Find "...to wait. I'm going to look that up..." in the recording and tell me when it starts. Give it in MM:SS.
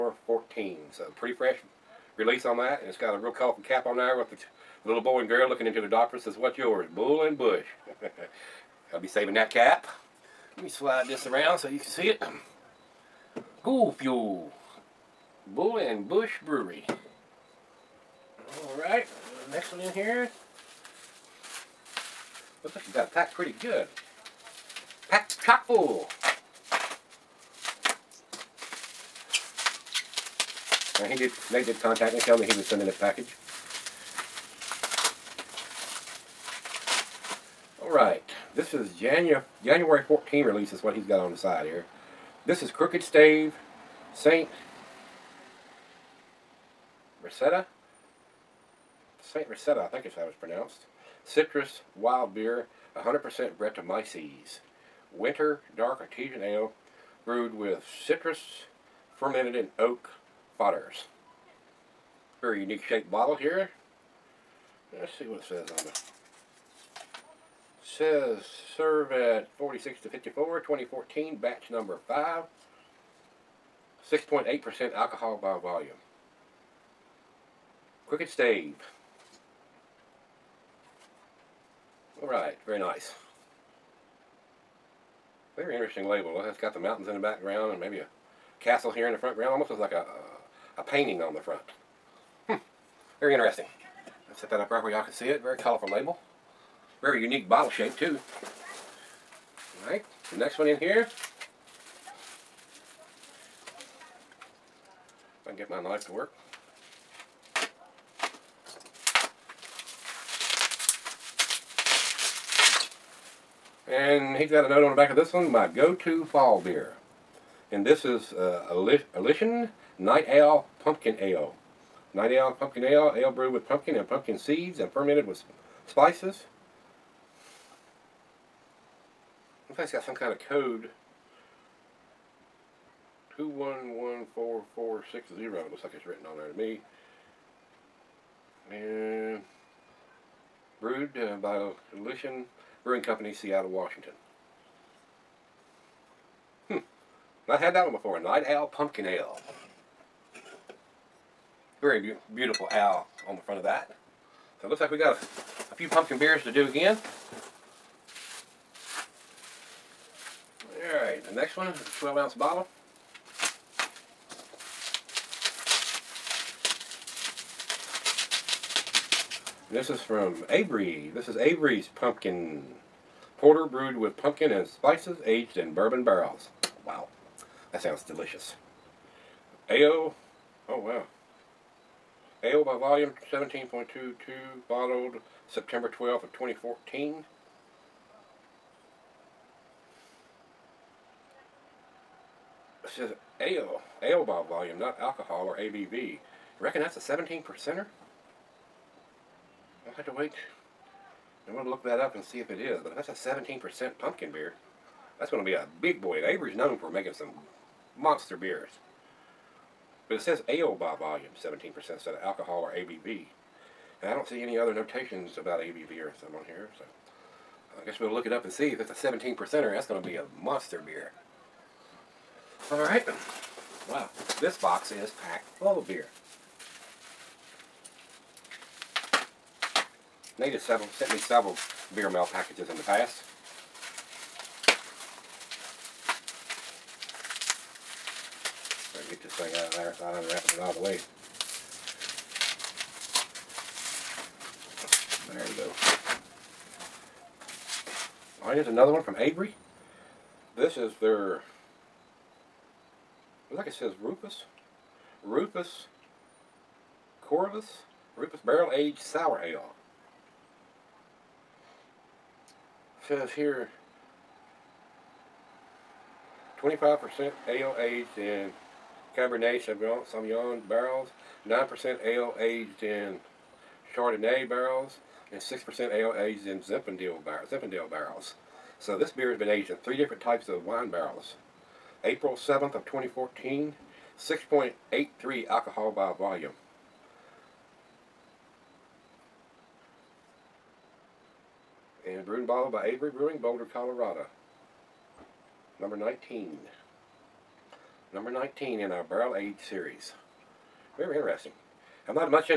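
03:20.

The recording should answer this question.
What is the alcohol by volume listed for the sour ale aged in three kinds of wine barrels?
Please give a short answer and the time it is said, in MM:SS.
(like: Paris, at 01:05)
6.83%, at 04:44.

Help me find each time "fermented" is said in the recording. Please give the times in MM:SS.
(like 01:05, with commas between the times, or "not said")
00:59, 02:04.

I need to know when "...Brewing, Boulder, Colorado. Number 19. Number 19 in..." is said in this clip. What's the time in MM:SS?
04:53.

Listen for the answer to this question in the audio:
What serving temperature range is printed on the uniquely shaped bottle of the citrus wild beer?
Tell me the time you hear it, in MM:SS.
01:09.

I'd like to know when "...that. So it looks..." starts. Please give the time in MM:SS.
02:33.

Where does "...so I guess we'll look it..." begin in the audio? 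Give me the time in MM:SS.
03:36.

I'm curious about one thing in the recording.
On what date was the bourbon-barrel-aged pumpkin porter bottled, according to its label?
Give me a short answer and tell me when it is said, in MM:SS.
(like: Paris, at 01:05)
September 12, 2014, at 03:05.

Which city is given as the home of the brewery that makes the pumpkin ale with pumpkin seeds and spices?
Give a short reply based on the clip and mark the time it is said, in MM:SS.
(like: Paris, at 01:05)
Seattle, Washington, at 02:23.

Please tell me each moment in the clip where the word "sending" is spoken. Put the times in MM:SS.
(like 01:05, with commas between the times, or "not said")
00:32.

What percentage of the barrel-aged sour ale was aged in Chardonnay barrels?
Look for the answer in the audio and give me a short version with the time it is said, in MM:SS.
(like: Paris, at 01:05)
9%, at 04:31.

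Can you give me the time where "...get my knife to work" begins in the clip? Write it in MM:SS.
01:45.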